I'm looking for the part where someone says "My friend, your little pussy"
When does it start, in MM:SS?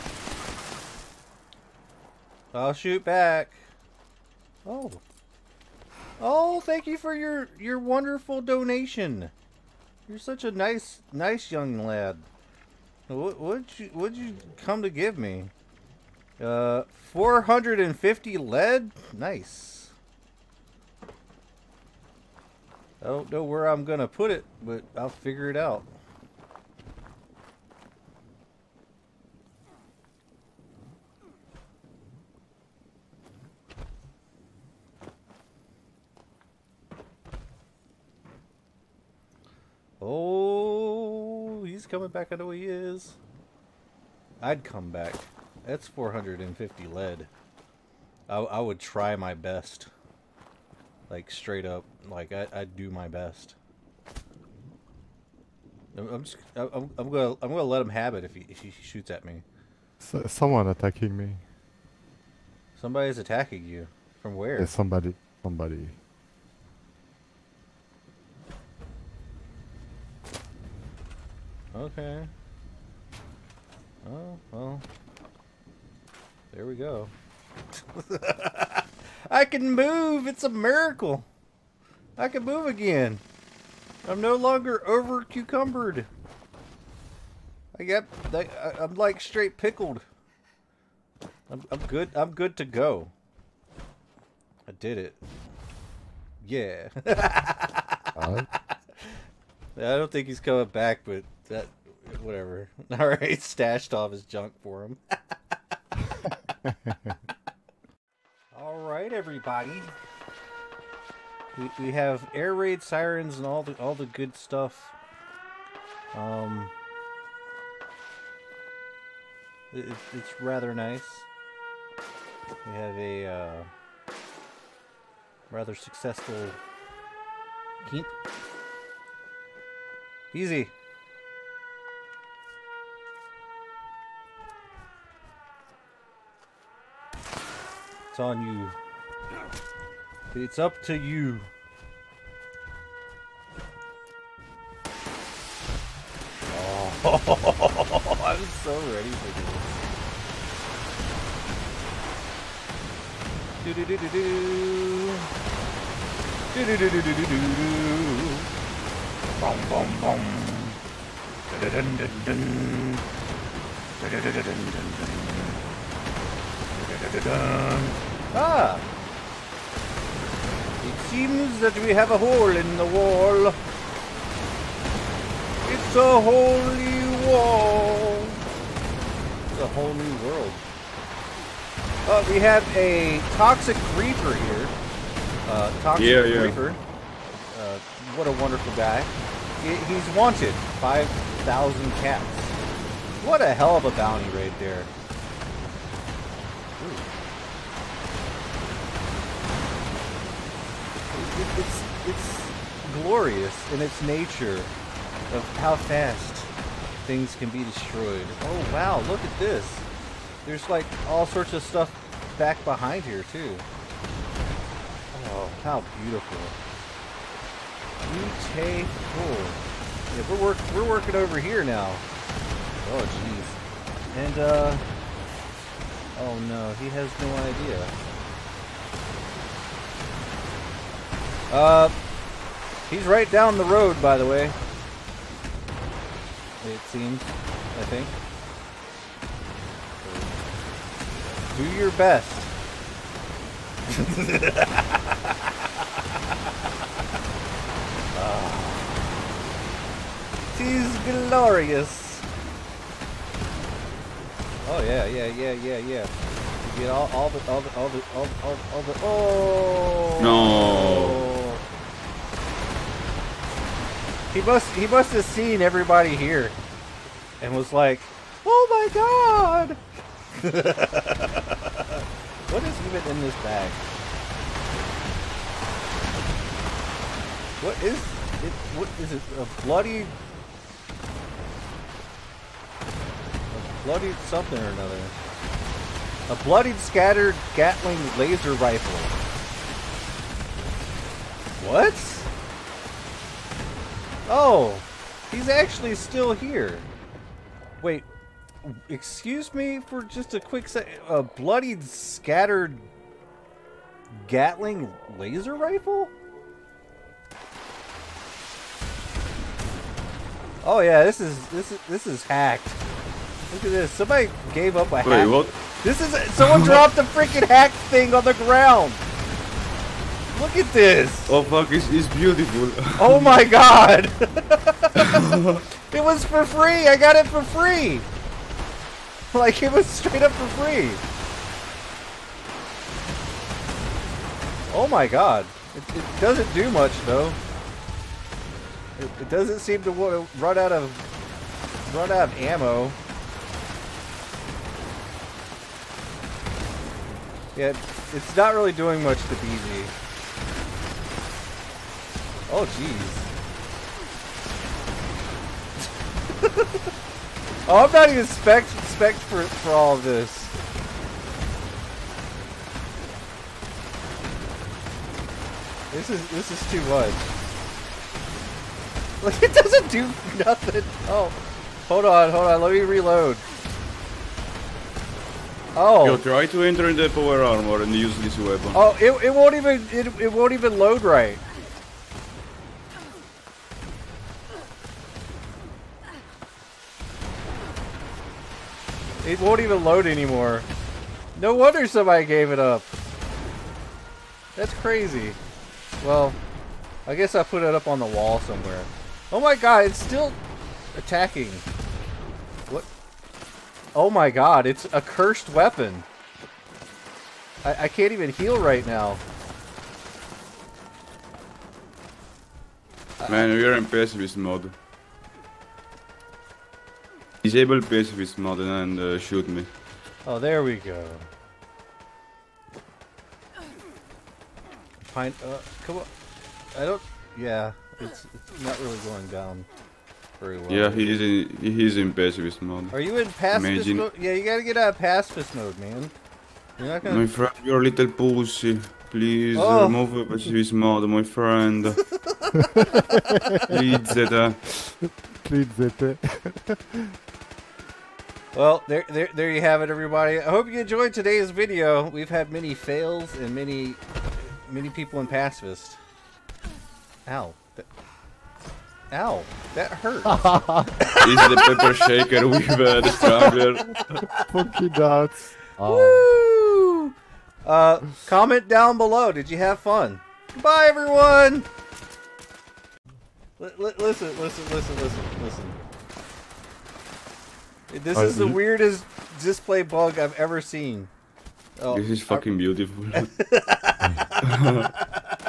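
07:17.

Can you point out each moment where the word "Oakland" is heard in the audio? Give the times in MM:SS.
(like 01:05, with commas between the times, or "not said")
not said.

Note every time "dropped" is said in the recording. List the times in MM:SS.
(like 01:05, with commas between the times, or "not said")
05:16.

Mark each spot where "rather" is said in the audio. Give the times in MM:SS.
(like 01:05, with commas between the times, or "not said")
02:00, 02:05.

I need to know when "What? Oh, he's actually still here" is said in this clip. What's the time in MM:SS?
04:51.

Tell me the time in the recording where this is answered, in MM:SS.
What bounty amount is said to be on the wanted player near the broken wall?
03:10.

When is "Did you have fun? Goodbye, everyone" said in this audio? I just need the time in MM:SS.
07:49.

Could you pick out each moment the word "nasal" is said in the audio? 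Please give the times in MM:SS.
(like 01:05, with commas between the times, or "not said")
not said.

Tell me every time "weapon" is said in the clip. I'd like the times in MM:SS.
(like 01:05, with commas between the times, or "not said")
06:18, 06:45.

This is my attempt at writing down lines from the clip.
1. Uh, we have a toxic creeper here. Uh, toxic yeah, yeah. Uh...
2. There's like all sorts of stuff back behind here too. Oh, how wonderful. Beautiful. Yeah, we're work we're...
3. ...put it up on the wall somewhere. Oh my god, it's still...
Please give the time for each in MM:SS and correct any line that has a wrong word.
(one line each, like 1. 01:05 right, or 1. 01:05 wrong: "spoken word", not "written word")
1. 03:02 right
2. 03:30 wrong: "beautiful", not "wonderful"
3. 06:37 right.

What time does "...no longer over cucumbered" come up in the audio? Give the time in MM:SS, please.
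01:24.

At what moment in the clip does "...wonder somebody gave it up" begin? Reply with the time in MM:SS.
06:31.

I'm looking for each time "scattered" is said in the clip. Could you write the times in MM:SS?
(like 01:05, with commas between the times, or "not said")
04:46, 05:01.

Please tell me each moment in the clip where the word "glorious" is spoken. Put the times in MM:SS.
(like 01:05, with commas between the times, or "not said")
03:23, 04:11.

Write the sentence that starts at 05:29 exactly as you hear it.
Like it was straight up for free.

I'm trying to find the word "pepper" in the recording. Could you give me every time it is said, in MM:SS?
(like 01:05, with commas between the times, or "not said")
07:41.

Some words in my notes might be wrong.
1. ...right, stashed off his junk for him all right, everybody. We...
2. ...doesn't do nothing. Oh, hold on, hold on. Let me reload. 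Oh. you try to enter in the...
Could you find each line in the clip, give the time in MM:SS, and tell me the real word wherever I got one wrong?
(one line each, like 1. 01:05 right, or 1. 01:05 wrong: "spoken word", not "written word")
1. 01:43 right
2. 06:09 right.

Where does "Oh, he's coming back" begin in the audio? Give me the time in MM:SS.
00:40.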